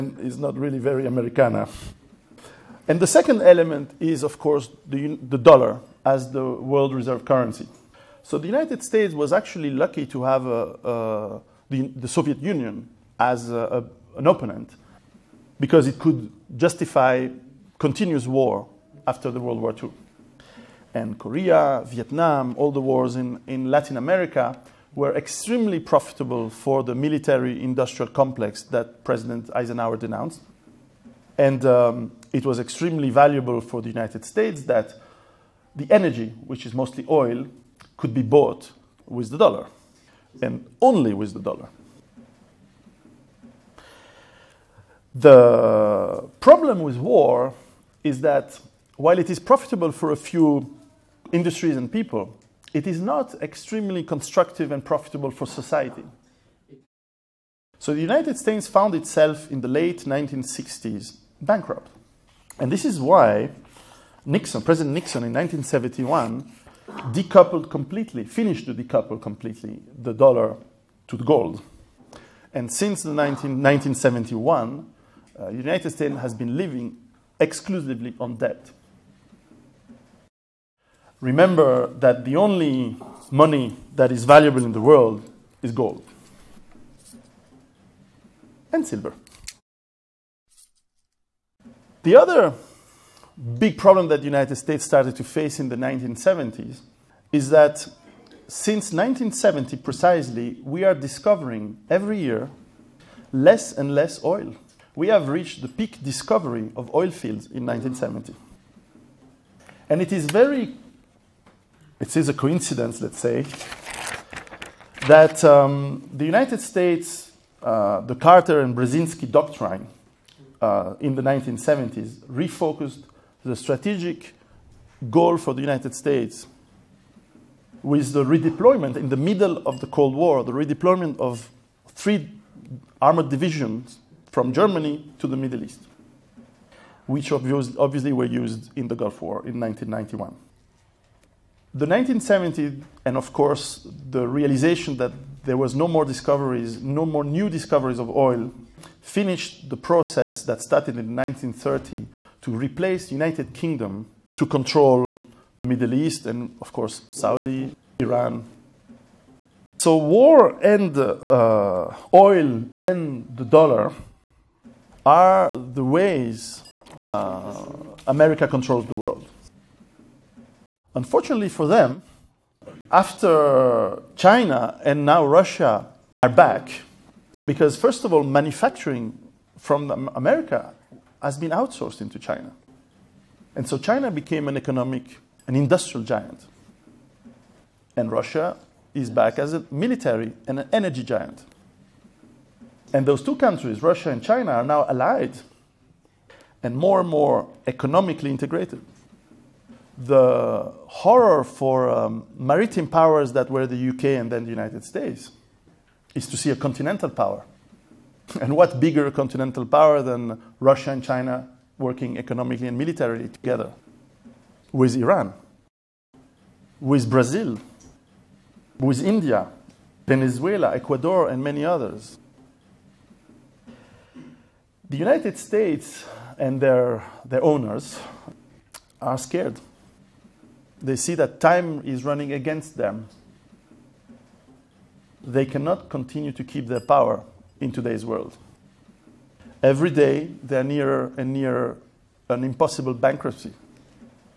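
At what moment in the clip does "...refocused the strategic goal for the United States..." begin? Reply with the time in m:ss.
2:02.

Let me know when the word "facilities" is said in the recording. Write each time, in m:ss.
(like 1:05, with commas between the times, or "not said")
not said.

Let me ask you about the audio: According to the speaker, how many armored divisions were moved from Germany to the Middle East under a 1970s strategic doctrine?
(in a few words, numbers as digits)
3.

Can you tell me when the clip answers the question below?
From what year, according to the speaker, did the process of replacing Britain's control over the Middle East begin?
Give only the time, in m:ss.
2:31.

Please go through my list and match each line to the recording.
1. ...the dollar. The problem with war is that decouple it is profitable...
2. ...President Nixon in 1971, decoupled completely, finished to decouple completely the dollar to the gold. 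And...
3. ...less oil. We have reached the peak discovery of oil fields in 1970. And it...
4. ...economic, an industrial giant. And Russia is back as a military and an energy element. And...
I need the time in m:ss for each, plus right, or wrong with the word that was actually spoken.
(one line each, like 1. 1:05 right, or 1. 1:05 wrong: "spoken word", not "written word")
1. 0:41 wrong: "while", not "decouple"
2. 1:04 right
3. 1:43 right
4. 3:04 wrong: "giant", not "element".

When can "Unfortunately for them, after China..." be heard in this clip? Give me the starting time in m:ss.
2:50.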